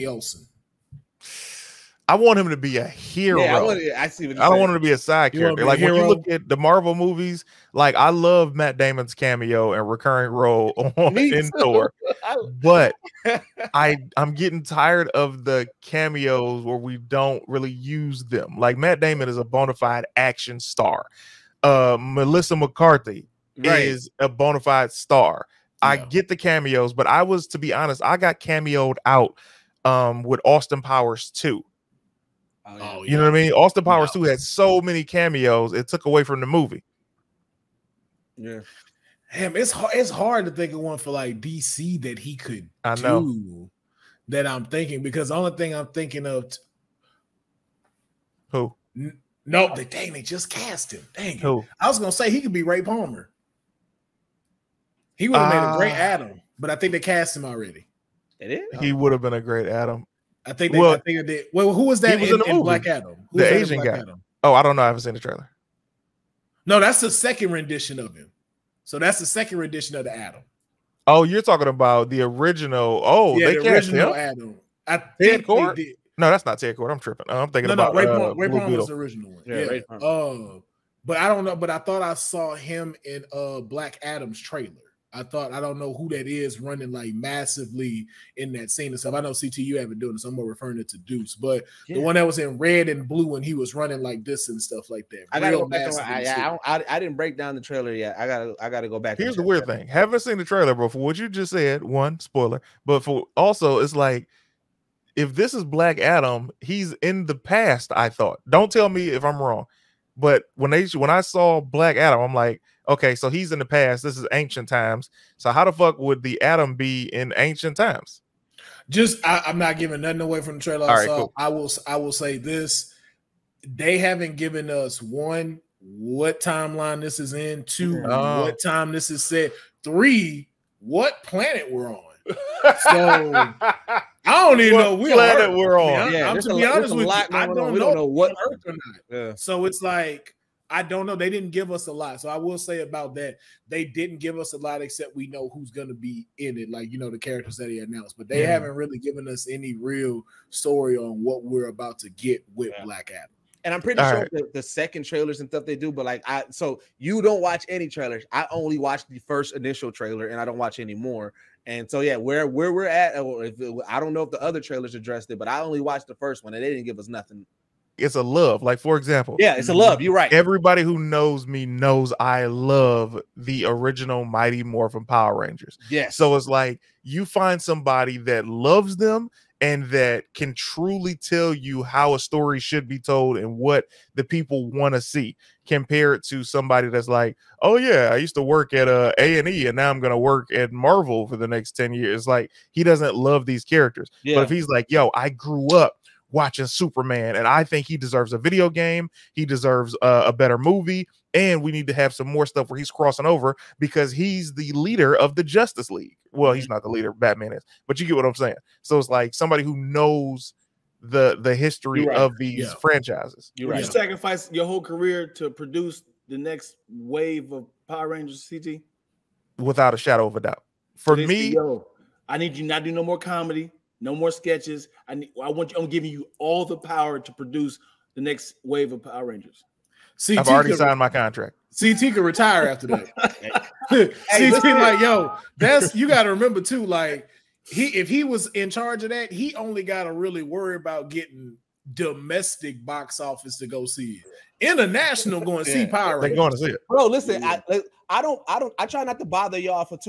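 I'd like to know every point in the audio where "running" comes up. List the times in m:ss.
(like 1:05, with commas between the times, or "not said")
1:26, 1:33.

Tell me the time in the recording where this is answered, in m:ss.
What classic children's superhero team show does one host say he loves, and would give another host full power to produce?
2:54.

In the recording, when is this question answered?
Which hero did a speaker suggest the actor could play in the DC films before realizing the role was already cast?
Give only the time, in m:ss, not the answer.
0:52.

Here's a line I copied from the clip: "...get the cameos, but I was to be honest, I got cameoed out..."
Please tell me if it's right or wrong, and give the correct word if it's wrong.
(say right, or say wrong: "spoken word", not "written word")
right.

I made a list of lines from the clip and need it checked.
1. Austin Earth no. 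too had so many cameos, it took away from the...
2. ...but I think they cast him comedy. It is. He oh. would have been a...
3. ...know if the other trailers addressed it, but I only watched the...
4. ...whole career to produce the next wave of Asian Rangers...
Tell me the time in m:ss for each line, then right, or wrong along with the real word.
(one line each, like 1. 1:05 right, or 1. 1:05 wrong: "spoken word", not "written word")
1. 0:33 wrong: "Powers", not "Earth"
2. 0:56 wrong: "already", not "comedy"
3. 2:44 right
4. 3:34 wrong: "Power", not "Asian".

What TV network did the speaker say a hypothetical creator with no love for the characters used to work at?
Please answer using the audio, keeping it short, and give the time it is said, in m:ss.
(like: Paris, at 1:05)
A&E, at 3:09.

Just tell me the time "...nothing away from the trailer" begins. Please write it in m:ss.
2:00.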